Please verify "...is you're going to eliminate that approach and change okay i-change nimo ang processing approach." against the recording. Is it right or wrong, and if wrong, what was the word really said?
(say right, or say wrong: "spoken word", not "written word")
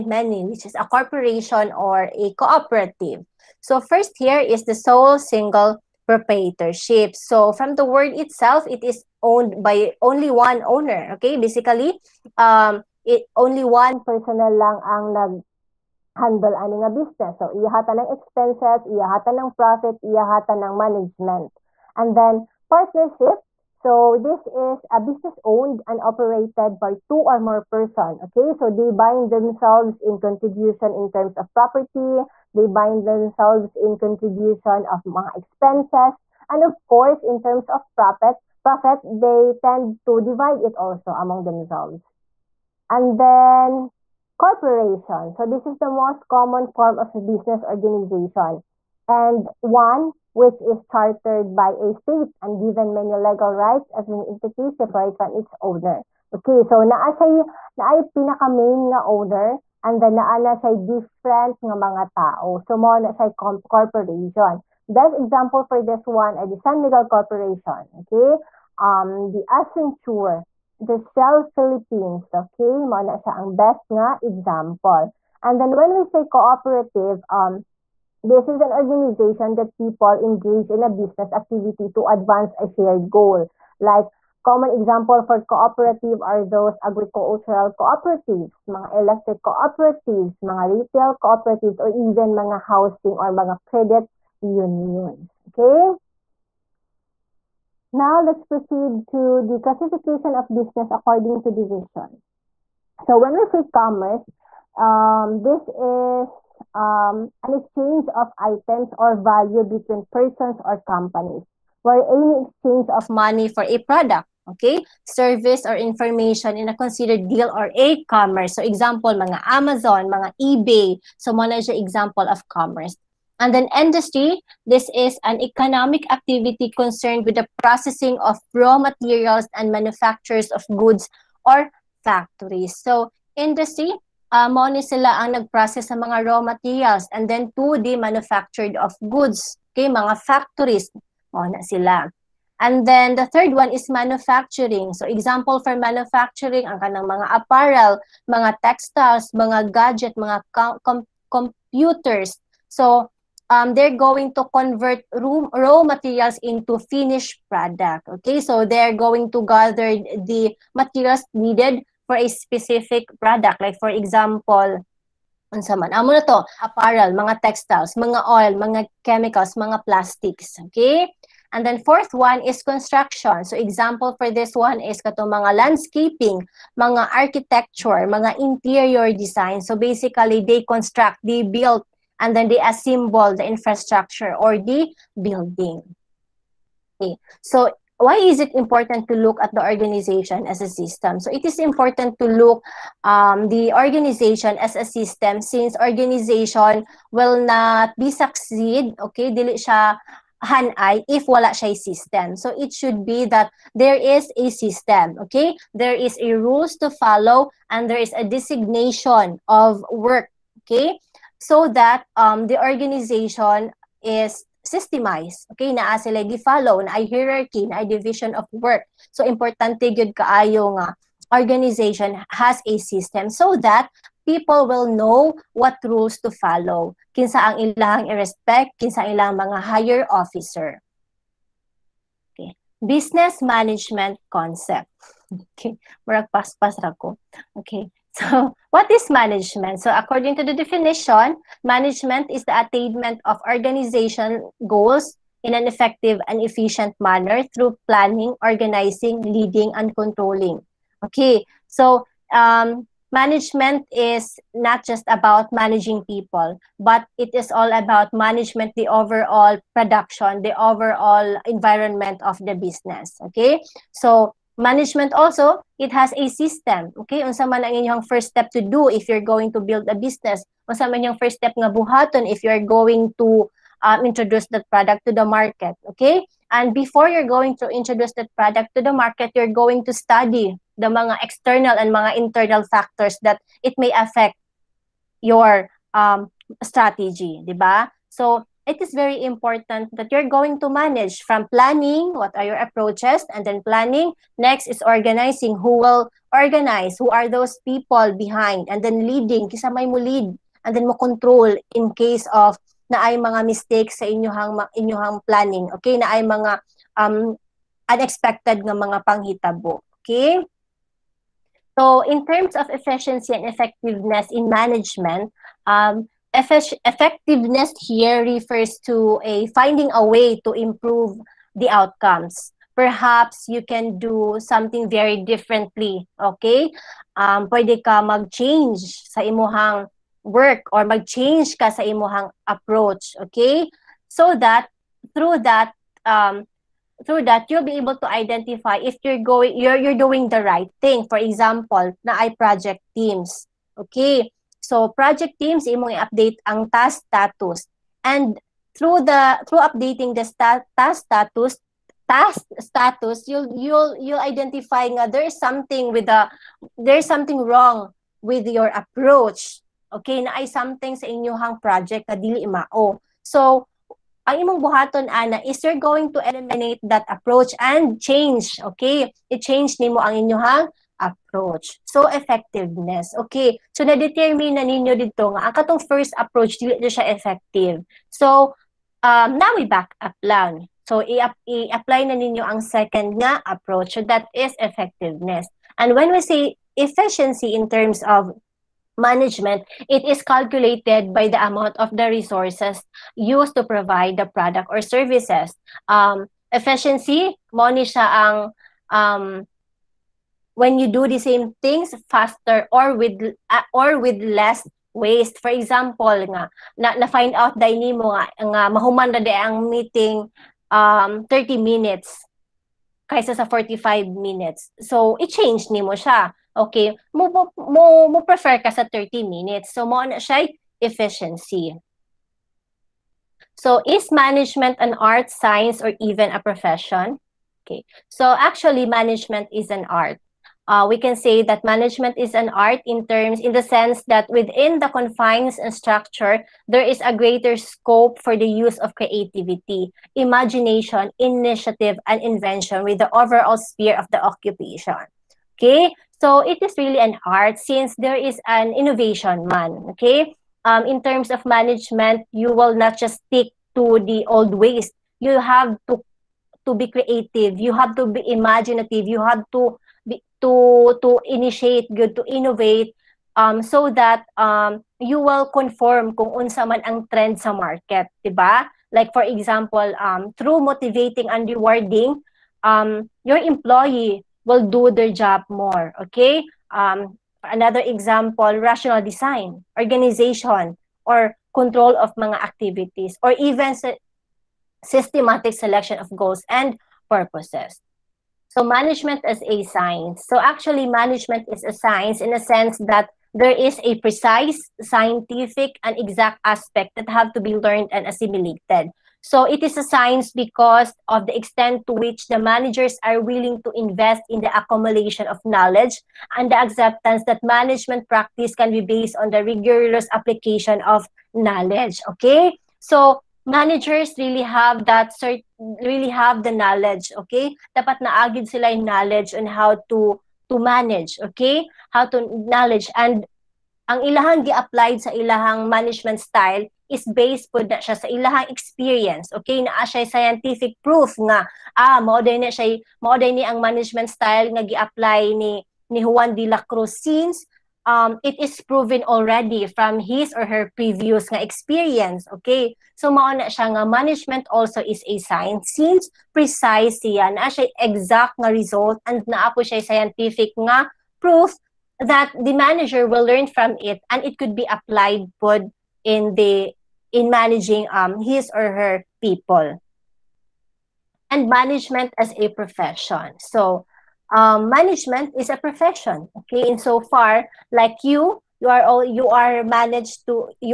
wrong: "inyong", not "processing".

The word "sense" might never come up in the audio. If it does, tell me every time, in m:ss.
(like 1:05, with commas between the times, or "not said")
7:13, 8:12.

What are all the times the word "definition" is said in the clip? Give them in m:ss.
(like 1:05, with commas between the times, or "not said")
4:00.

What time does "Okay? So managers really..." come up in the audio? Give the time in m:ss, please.
8:32.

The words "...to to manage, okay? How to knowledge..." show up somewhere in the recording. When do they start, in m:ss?
8:39.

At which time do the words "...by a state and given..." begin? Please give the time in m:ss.
0:51.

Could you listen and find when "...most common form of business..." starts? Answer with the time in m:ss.
0:45.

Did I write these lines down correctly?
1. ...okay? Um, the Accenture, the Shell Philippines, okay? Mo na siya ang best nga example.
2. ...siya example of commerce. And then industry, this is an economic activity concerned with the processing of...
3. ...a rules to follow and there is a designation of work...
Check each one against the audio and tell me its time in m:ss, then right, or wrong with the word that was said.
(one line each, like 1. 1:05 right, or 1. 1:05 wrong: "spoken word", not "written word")
1. 1:07 right
2. 2:01 right
3. 3:26 right.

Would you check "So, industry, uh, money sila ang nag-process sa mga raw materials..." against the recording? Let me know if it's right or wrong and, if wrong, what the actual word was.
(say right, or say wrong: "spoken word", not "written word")
right.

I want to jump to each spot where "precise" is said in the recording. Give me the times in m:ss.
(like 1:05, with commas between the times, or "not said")
8:14, 9:06.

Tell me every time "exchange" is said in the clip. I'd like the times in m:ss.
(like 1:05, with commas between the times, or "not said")
1:47, 1:52.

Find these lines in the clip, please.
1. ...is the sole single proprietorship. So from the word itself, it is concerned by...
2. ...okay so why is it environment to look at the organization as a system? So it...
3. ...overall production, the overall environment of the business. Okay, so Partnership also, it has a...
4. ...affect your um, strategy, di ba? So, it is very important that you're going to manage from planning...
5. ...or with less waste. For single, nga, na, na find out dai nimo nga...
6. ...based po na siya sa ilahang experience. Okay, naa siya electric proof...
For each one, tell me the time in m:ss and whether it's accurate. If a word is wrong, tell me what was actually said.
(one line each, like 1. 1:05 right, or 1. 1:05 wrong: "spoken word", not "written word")
1. 0:04 wrong: "owned", not "concerned"
2. 3:06 wrong: "important", not "environment"
3. 4:18 wrong: "Management", not "Partnership"
4. 4:43 right
5. 6:43 wrong: "example", not "single"
6. 8:47 wrong: "scientific", not "electric".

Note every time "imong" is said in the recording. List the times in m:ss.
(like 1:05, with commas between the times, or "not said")
5:45, 6:04.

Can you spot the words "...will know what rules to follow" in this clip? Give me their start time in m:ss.
3:44.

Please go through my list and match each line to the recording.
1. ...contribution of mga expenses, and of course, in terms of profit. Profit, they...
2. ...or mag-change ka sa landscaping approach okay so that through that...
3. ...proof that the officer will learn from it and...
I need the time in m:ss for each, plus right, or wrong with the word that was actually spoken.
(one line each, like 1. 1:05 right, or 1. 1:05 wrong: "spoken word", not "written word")
1. 0:33 right
2. 5:30 wrong: "imuhang", not "landscaping"
3. 9:11 wrong: "manager", not "officer".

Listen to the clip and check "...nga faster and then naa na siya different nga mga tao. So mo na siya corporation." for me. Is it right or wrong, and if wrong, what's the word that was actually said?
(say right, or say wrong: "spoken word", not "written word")
wrong: "owner", not "faster".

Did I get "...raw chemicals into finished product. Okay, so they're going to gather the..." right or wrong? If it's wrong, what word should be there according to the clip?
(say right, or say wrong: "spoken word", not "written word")
wrong: "materials", not "chemicals".